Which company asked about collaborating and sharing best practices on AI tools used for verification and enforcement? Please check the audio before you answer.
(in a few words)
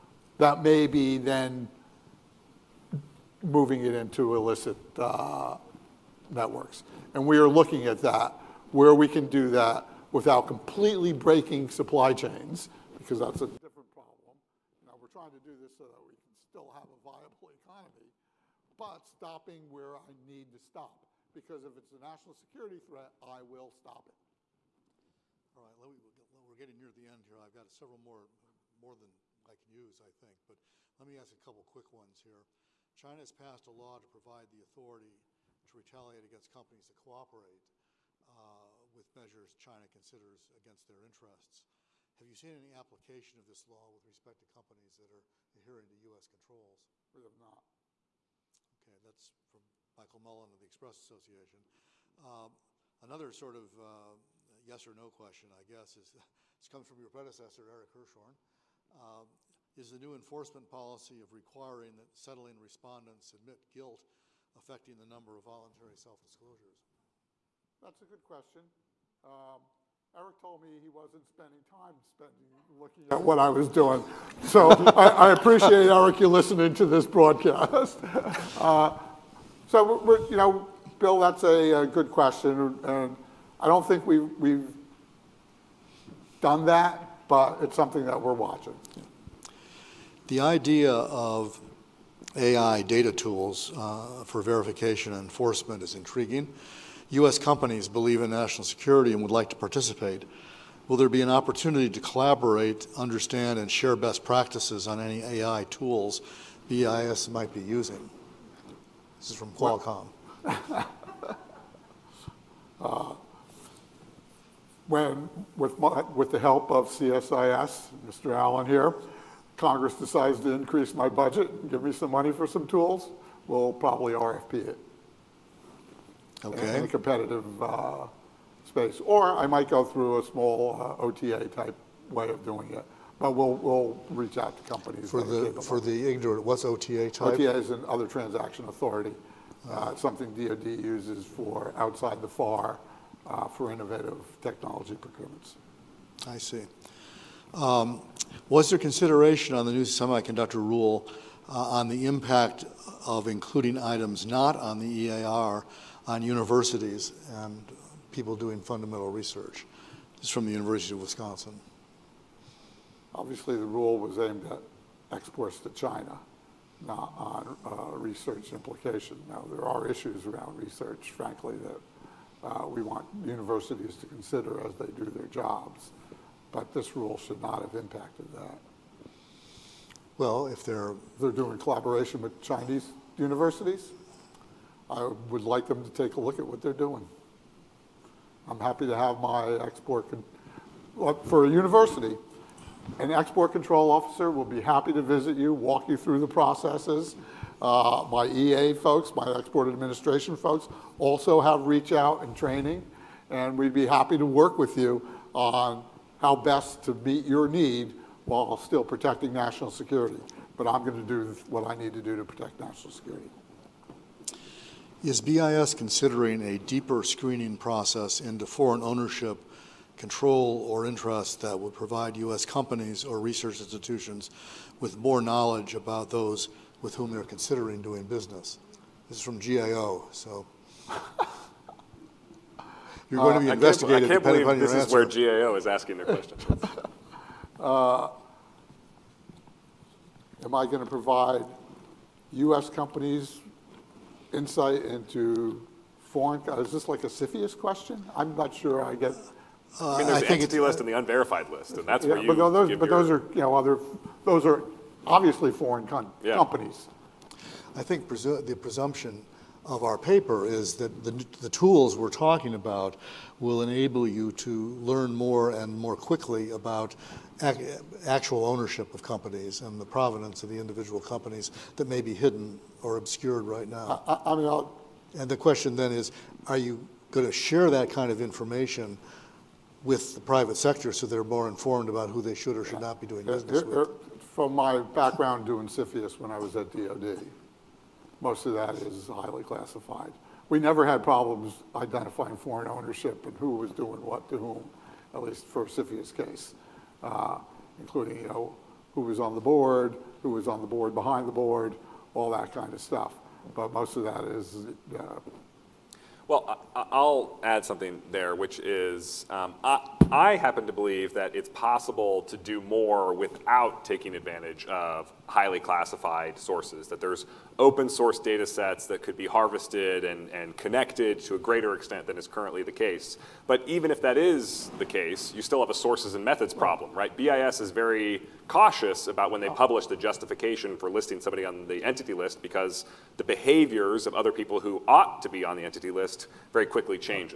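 Qualcomm.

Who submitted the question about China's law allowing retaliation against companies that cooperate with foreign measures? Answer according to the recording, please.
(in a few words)
Michael Mullen.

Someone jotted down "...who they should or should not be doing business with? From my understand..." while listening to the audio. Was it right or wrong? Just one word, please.
wrong.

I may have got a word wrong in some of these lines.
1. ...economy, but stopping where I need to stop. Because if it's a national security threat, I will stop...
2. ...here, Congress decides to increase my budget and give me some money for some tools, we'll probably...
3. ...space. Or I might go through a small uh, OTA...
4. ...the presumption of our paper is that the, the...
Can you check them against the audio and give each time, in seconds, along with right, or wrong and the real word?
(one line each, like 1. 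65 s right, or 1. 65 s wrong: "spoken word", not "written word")
1. 17 s right
2. 118 s right
3. 128 s right
4. 258 s right.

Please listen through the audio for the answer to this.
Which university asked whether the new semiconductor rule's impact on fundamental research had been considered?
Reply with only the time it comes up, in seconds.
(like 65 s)
160 s.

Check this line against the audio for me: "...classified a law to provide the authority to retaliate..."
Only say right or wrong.
wrong.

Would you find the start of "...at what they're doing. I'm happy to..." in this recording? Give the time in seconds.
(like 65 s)
186 s.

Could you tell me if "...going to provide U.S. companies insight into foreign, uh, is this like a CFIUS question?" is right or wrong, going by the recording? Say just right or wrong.
right.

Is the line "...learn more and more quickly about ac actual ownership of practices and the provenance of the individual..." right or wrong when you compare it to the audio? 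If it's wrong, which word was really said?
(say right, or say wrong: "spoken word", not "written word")
wrong: "companies", not "practices".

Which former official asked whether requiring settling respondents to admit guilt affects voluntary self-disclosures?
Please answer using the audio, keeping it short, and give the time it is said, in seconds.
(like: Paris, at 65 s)
Eric Hirschhorn, at 57 s.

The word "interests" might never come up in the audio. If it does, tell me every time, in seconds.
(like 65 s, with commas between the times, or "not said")
41 s, 220 s.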